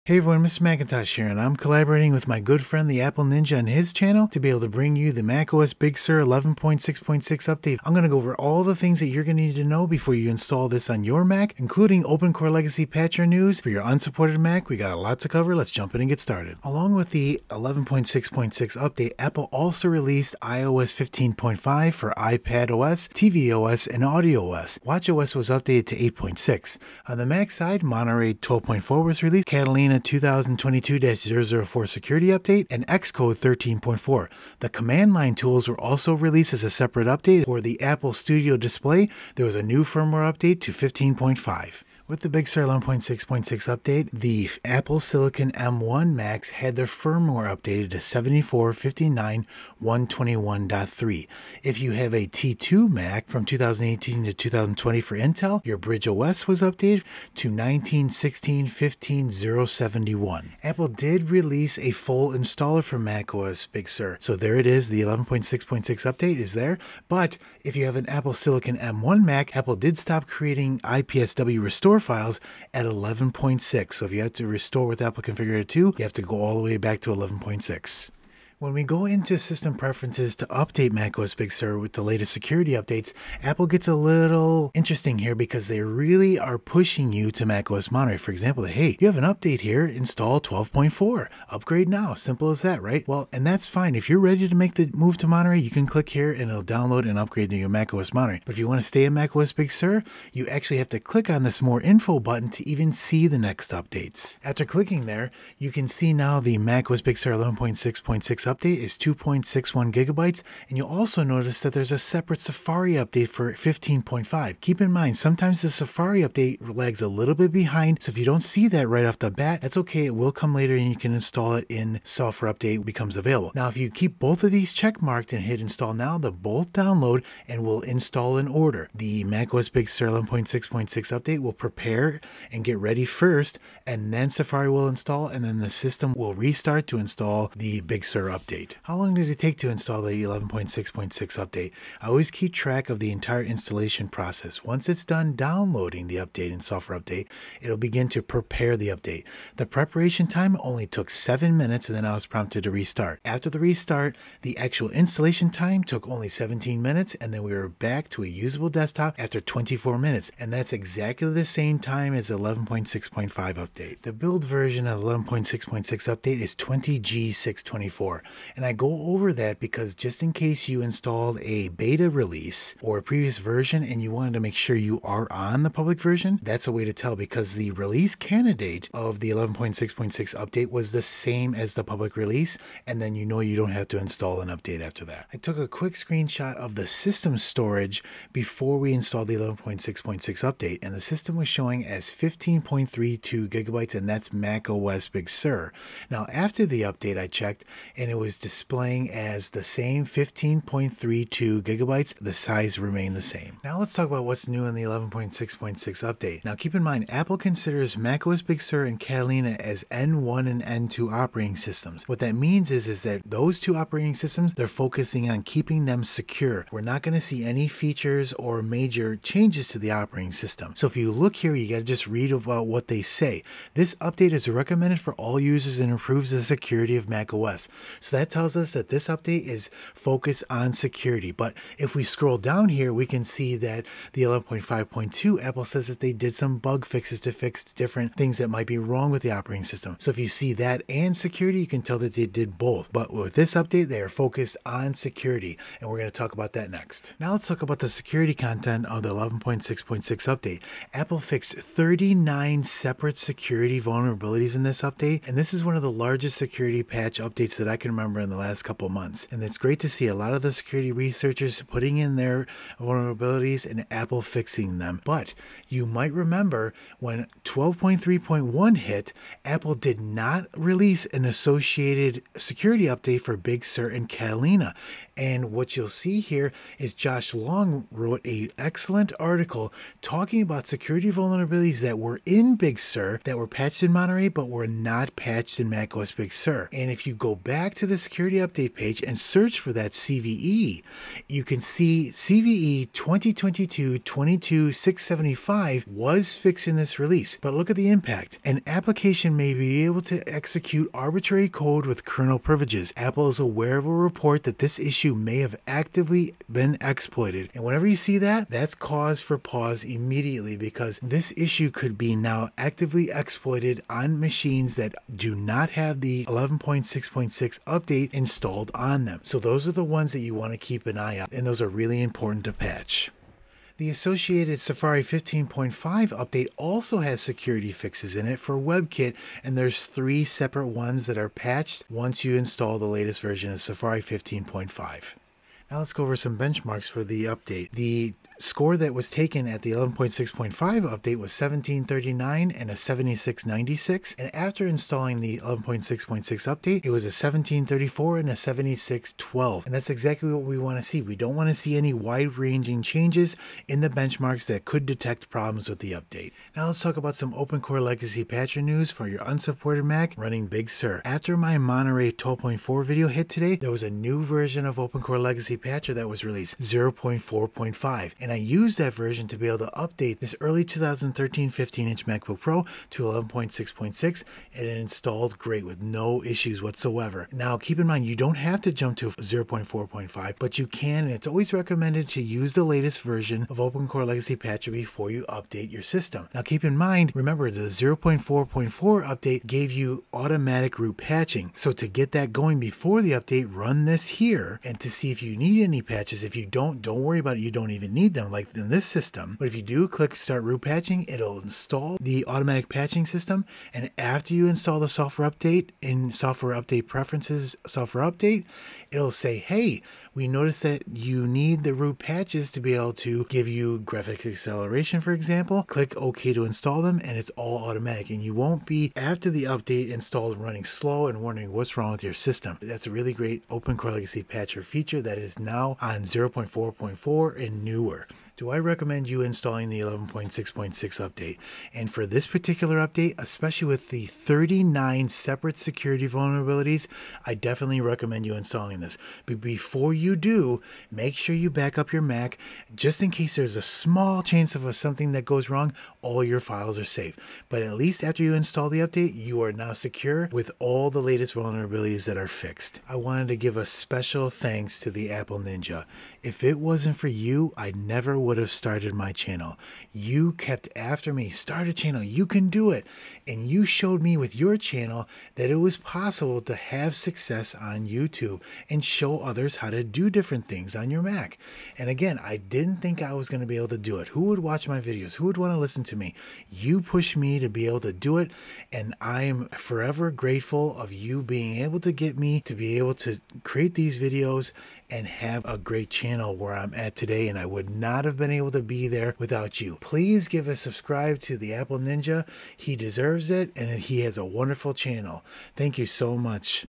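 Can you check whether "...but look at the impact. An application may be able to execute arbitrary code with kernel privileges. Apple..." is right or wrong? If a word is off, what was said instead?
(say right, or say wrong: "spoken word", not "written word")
right.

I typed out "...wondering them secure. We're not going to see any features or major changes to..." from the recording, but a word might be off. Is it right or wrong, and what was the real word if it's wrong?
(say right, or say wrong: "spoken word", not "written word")
wrong: "keeping", not "wondering".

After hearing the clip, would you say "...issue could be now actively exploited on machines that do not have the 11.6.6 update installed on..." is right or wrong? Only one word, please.
right.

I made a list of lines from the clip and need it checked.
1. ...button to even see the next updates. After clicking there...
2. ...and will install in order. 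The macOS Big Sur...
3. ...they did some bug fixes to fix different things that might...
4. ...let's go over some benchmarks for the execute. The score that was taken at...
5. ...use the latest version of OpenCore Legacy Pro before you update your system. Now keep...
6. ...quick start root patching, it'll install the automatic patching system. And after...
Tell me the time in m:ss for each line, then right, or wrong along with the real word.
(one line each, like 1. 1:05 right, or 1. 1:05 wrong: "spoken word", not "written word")
1. 1:42 right
2. 2:07 right
3. 3:55 right
4. 5:35 wrong: "update", not "execute"
5. 6:22 wrong: "Patcher", not "Pro"
6. 6:39 wrong: "click", not "quick".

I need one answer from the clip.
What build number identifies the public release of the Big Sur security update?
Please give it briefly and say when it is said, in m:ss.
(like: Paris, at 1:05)
20G624, at 2:46.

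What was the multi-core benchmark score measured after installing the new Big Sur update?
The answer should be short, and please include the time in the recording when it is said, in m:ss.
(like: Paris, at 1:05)
7612, at 5:48.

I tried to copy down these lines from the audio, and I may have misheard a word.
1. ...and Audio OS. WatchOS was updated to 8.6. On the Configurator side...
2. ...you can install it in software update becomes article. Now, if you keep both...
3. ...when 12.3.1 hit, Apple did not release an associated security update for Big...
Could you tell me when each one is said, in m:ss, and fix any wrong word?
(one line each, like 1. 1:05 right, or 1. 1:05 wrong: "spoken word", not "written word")
1. 0:23 wrong: "Mac", not "Configurator"
2. 2:00 wrong: "available", not "article"
3. 4:26 right.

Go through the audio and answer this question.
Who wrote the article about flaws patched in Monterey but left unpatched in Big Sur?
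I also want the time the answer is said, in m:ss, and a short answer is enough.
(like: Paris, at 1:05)
Josh Long, at 4:36.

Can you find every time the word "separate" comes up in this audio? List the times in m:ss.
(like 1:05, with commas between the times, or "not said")
0:36, 1:51, 4:12, 5:30, 7:15.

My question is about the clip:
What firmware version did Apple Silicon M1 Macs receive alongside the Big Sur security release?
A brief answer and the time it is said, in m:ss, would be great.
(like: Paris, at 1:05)
7459.121.3, at 0:49.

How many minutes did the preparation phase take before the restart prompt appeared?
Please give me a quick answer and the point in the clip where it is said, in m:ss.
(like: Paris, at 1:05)
7, at 2:31.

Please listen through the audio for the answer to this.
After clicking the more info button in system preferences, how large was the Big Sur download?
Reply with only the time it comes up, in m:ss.
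1:48.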